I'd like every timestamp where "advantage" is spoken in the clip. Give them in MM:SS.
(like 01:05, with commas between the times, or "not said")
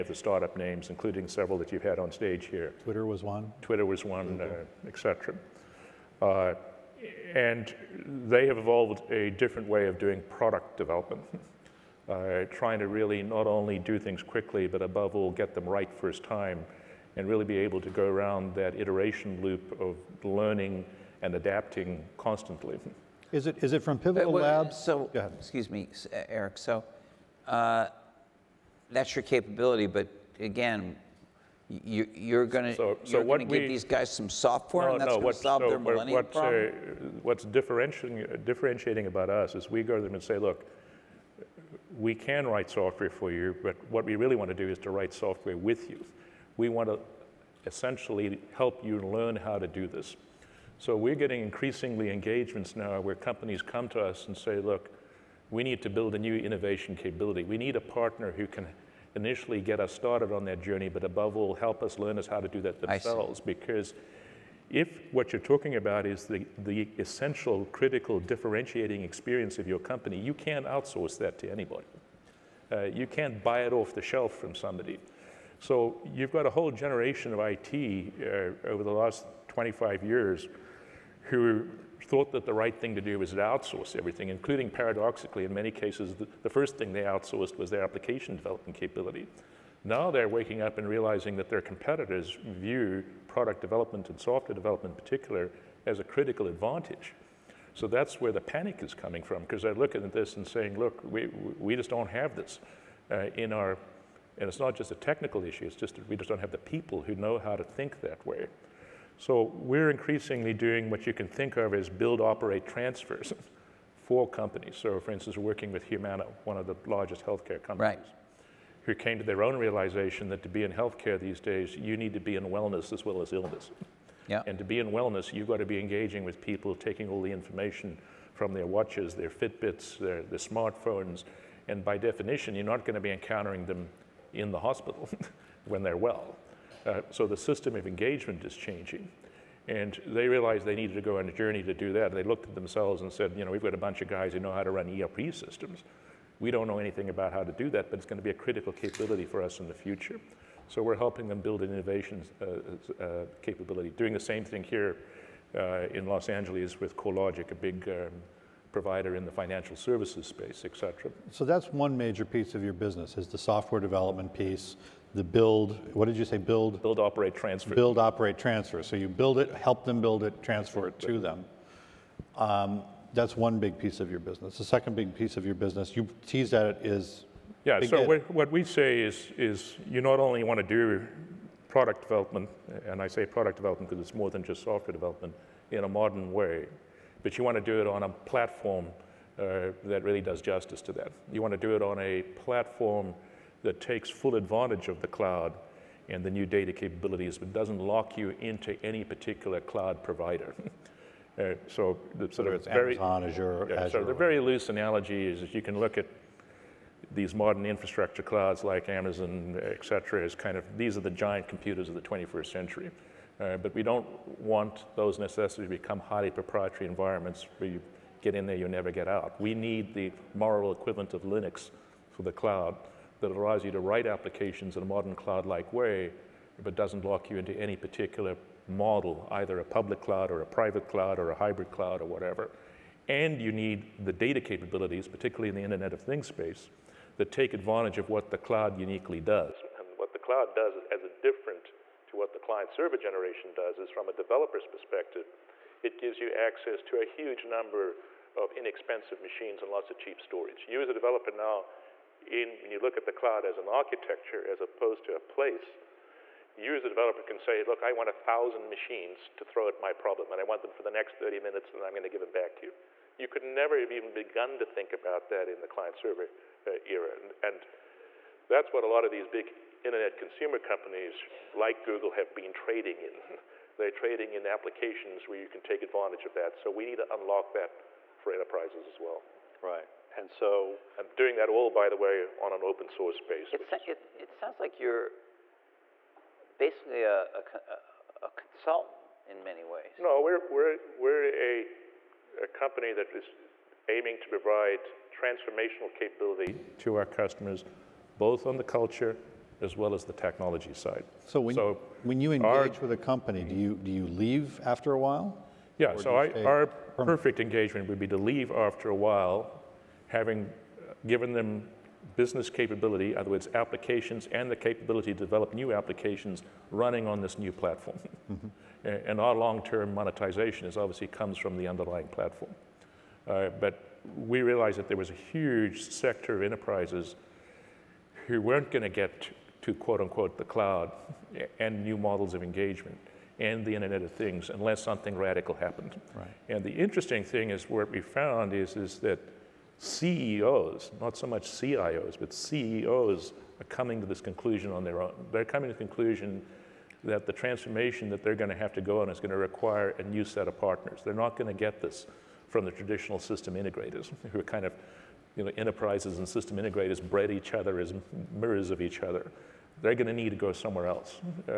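01:36, 03:14, 03:57, 04:35.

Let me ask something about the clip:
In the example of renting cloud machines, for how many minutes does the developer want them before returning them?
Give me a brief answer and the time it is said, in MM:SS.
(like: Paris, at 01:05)
30, at 04:21.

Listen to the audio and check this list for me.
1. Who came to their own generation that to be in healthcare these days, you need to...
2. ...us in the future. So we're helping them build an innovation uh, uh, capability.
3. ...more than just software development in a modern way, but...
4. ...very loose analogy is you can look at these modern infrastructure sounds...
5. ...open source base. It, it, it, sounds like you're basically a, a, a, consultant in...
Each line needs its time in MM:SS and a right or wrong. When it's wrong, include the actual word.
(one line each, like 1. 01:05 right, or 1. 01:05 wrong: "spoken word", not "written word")
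1. 01:58 wrong: "realization", not "generation"
2. 02:29 right
3. 03:04 right
4. 03:24 wrong: "clouds", not "sounds"
5. 04:42 right.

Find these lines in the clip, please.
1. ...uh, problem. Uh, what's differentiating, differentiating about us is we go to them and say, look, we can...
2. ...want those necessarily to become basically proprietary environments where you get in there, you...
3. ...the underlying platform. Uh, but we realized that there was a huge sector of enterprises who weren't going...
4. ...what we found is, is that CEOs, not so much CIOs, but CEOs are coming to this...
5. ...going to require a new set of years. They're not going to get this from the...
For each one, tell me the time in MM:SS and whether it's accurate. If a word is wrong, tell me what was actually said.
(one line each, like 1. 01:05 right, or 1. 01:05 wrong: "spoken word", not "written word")
1. 00:36 right
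2. 03:34 wrong: "highly", not "basically"
3. 05:21 right
4. 05:37 right
5. 05:49 wrong: "partners", not "years".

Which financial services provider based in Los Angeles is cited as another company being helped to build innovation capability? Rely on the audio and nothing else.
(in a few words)
CoreLogic.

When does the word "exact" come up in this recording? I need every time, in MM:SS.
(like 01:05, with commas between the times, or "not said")
not said.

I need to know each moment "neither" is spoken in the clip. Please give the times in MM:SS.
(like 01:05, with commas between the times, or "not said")
not said.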